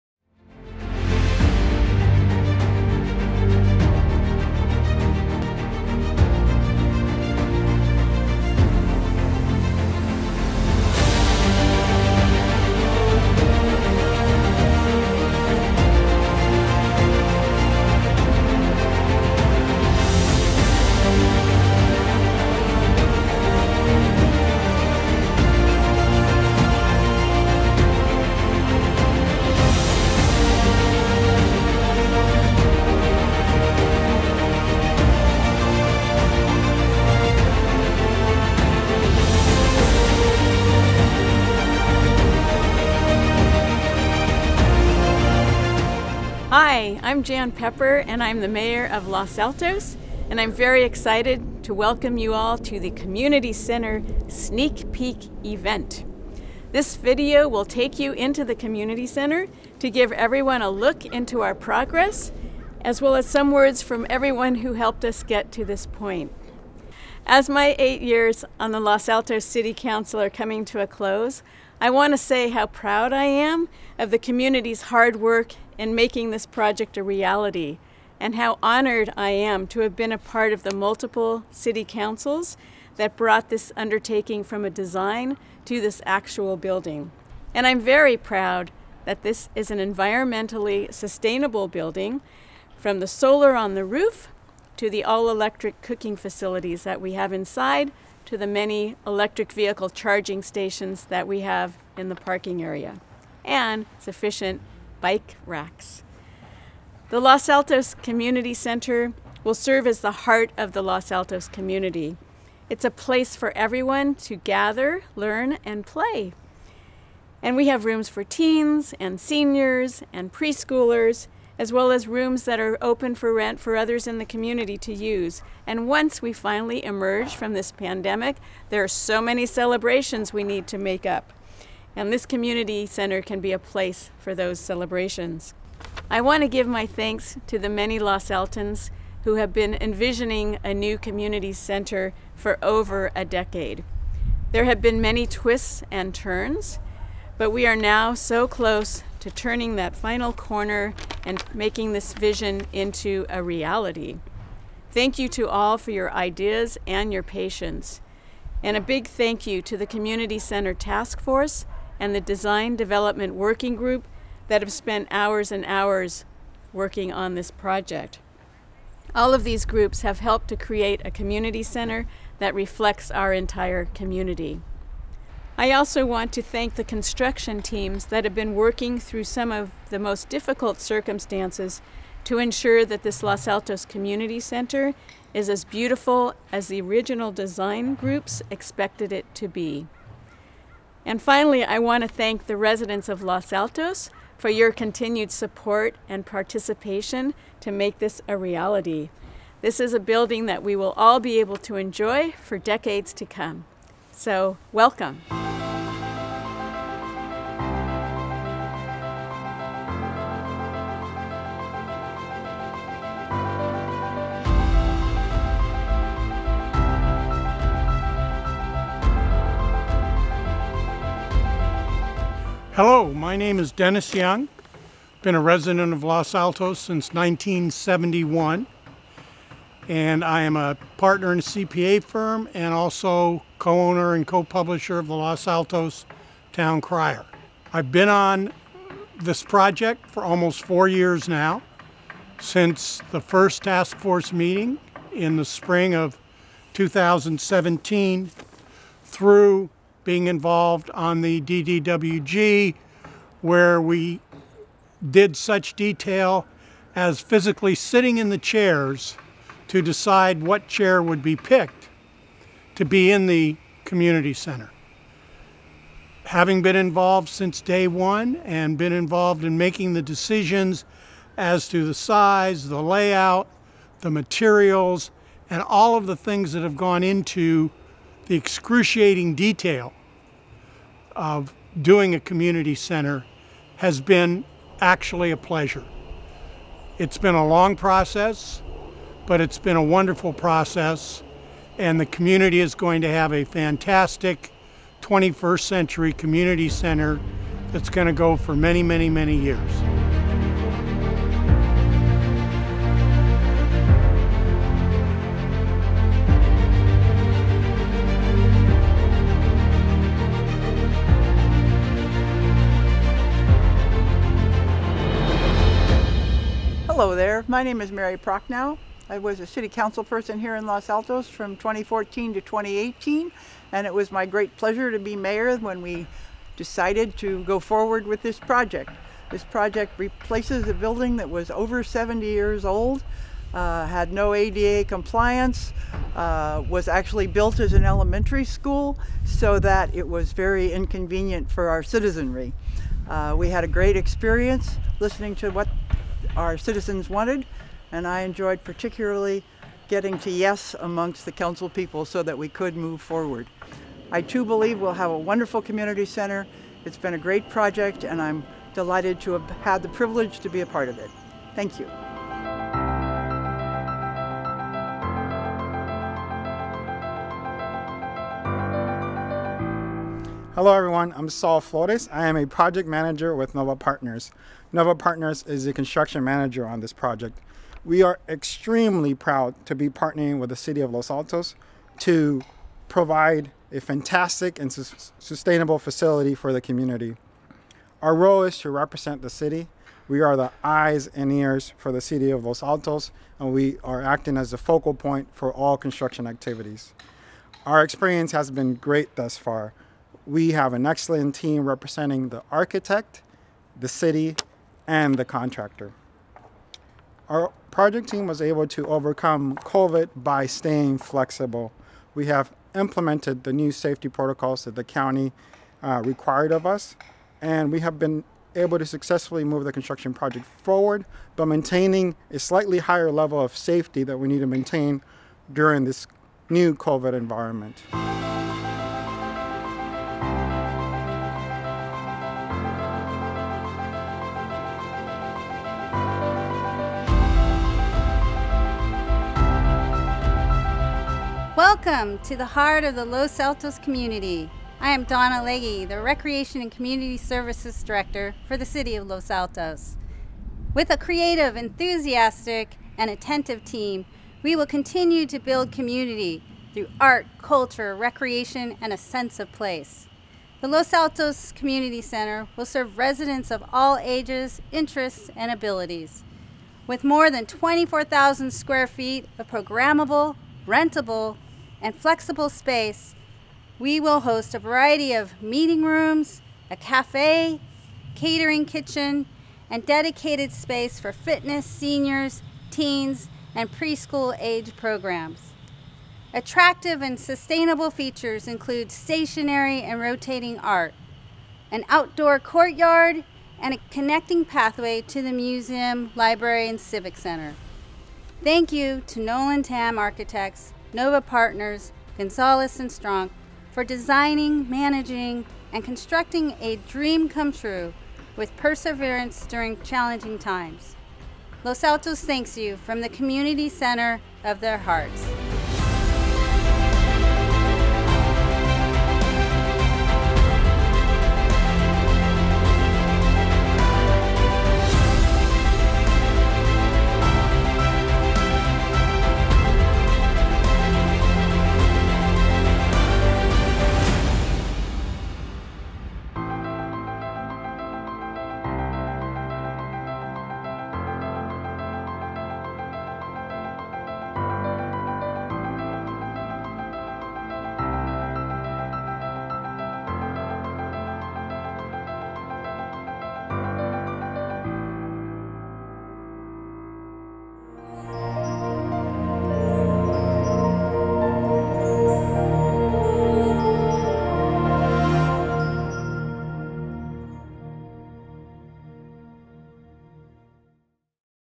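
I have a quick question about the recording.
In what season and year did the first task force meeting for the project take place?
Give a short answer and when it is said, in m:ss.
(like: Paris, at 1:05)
Spring 2017, at 4:05.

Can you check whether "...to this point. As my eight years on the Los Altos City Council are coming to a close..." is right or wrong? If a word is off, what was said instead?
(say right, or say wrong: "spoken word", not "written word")
right.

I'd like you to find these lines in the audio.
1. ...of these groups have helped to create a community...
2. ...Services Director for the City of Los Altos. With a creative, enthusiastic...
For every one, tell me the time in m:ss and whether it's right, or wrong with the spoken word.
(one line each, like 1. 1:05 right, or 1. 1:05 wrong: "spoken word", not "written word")
1. 2:49 right
2. 7:27 right.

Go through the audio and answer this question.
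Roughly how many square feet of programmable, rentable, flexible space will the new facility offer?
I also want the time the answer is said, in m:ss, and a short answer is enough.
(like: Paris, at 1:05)
24,000, at 7:47.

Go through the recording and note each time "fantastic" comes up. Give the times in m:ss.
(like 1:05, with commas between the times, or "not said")
4:53, 6:23.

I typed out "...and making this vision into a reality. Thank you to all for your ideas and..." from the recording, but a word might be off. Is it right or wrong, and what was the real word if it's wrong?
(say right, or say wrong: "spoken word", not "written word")
right.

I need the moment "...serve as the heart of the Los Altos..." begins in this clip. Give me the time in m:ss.
1:49.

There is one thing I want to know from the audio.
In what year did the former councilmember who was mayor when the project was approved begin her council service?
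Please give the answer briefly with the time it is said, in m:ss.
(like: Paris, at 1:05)
2014, at 5:21.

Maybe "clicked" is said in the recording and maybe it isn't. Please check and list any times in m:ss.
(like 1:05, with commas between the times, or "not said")
not said.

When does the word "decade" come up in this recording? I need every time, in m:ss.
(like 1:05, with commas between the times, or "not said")
2:23, 3:22.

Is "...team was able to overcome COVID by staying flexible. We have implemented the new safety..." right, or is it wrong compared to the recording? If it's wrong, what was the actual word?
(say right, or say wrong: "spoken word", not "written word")
right.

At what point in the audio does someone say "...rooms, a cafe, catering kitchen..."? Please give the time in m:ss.
7:55.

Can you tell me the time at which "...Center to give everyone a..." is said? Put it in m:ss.
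0:59.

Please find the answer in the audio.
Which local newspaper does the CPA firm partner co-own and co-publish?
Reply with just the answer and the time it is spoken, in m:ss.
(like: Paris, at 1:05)
Los Altos Town Crier, at 3:55.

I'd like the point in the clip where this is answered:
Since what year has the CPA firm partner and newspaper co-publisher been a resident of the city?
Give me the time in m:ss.
3:47.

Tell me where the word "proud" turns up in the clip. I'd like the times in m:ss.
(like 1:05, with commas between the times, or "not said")
1:12, 1:28, 6:19.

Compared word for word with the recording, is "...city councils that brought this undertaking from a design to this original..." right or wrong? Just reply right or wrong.
wrong.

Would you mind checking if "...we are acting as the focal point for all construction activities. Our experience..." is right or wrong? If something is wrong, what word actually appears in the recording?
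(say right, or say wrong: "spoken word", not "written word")
right.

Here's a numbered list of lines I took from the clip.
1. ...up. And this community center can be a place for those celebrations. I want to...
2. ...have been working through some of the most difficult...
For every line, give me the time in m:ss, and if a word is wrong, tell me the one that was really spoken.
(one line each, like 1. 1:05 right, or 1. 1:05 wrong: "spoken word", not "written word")
1. 2:11 right
2. 2:58 right.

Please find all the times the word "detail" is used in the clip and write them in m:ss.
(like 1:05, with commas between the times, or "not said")
4:15, 4:39.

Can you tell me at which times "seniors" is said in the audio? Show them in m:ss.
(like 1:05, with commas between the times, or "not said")
1:59, 8:01.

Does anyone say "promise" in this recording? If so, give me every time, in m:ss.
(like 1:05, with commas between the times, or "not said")
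not said.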